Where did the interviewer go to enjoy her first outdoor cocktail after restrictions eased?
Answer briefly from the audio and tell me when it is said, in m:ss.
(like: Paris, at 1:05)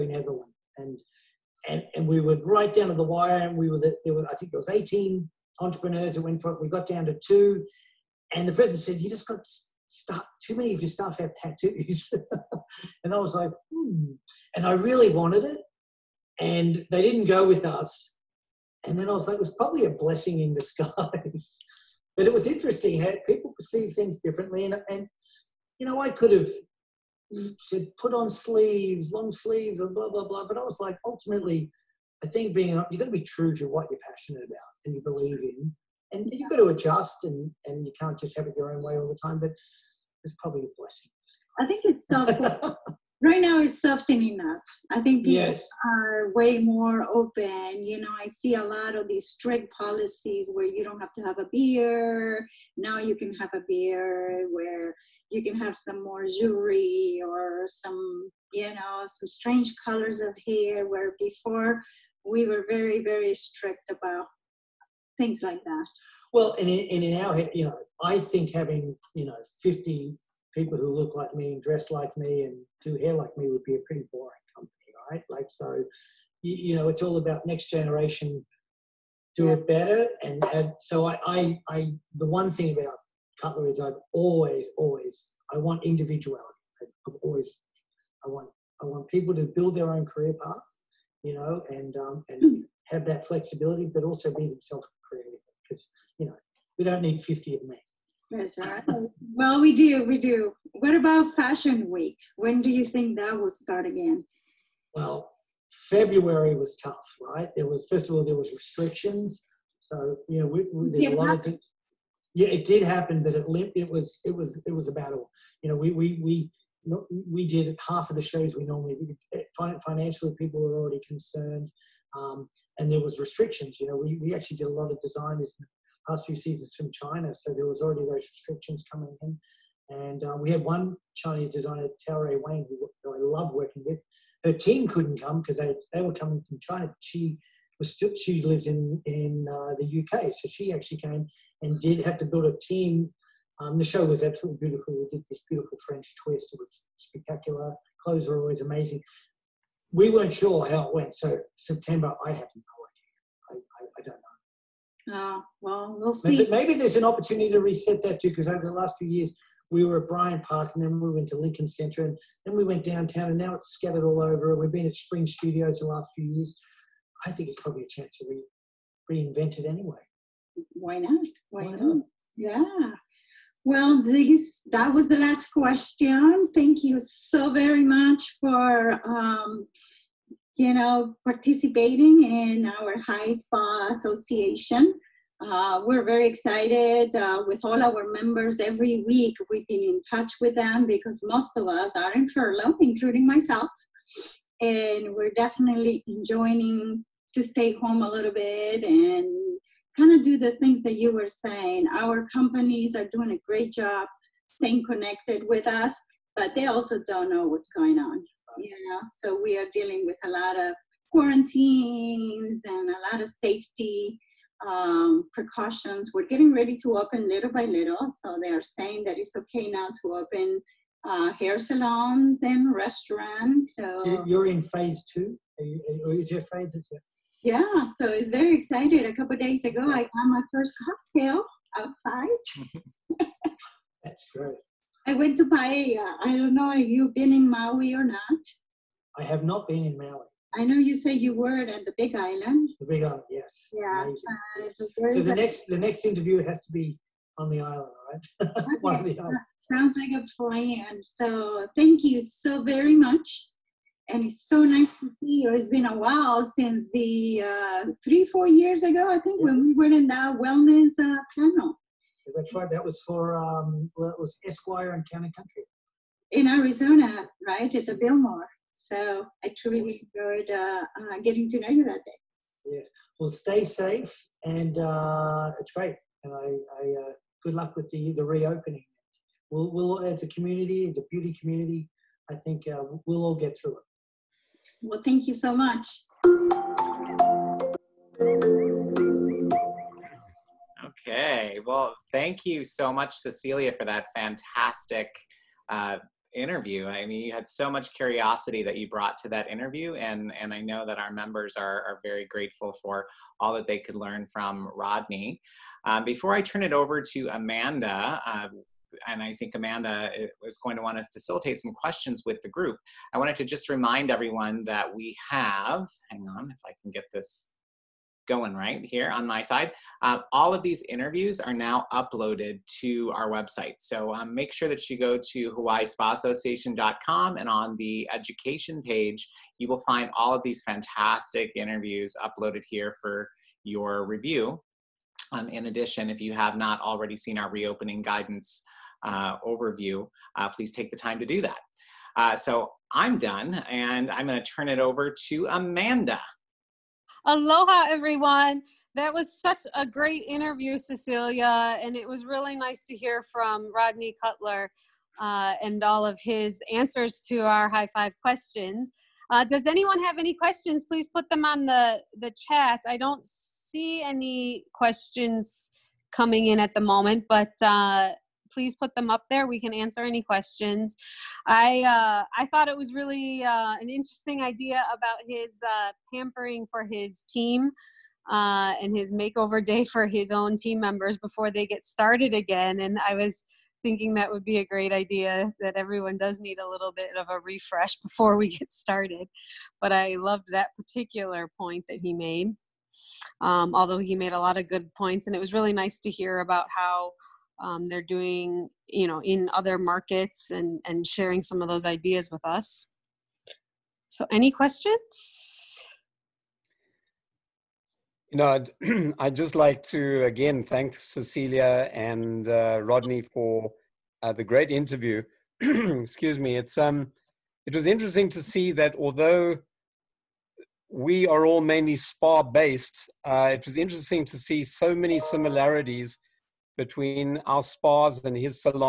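Paia, at 3:55.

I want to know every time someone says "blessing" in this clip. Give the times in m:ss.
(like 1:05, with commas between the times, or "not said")
0:19, 0:40.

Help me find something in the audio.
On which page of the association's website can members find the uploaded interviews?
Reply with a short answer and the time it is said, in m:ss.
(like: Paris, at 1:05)
education page, at 5:28.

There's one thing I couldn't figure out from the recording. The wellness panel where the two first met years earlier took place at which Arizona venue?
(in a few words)
Biltmore.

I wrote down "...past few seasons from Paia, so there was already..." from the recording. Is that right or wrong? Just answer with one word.
wrong.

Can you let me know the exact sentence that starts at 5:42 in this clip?
Uh, so I'm done and I'm going to turn it over to Amanda.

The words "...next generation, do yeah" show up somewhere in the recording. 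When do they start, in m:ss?
1:17.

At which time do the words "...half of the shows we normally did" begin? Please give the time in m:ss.
1:57.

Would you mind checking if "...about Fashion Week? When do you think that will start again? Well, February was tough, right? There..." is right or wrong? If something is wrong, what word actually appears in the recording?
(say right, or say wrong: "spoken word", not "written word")
right.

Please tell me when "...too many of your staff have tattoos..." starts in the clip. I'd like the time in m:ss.
0:10.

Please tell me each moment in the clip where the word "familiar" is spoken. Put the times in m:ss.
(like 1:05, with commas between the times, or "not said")
not said.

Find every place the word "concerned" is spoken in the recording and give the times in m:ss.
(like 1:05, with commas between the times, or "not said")
2:01.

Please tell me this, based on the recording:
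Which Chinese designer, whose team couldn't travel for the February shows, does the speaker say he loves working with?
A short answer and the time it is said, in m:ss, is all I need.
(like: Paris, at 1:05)
Taoray Wang, at 2:12.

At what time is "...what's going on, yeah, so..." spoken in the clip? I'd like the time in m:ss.
3:27.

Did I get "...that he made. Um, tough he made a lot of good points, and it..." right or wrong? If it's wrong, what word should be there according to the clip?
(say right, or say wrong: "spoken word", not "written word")
wrong: "although", not "tough".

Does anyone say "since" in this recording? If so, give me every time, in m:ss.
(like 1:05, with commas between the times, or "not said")
4:16.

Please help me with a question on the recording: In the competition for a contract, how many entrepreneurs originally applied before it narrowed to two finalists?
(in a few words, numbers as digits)
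18.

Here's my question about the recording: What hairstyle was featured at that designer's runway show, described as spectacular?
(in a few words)
French twist.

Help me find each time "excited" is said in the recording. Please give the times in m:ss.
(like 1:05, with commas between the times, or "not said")
3:06, 3:48.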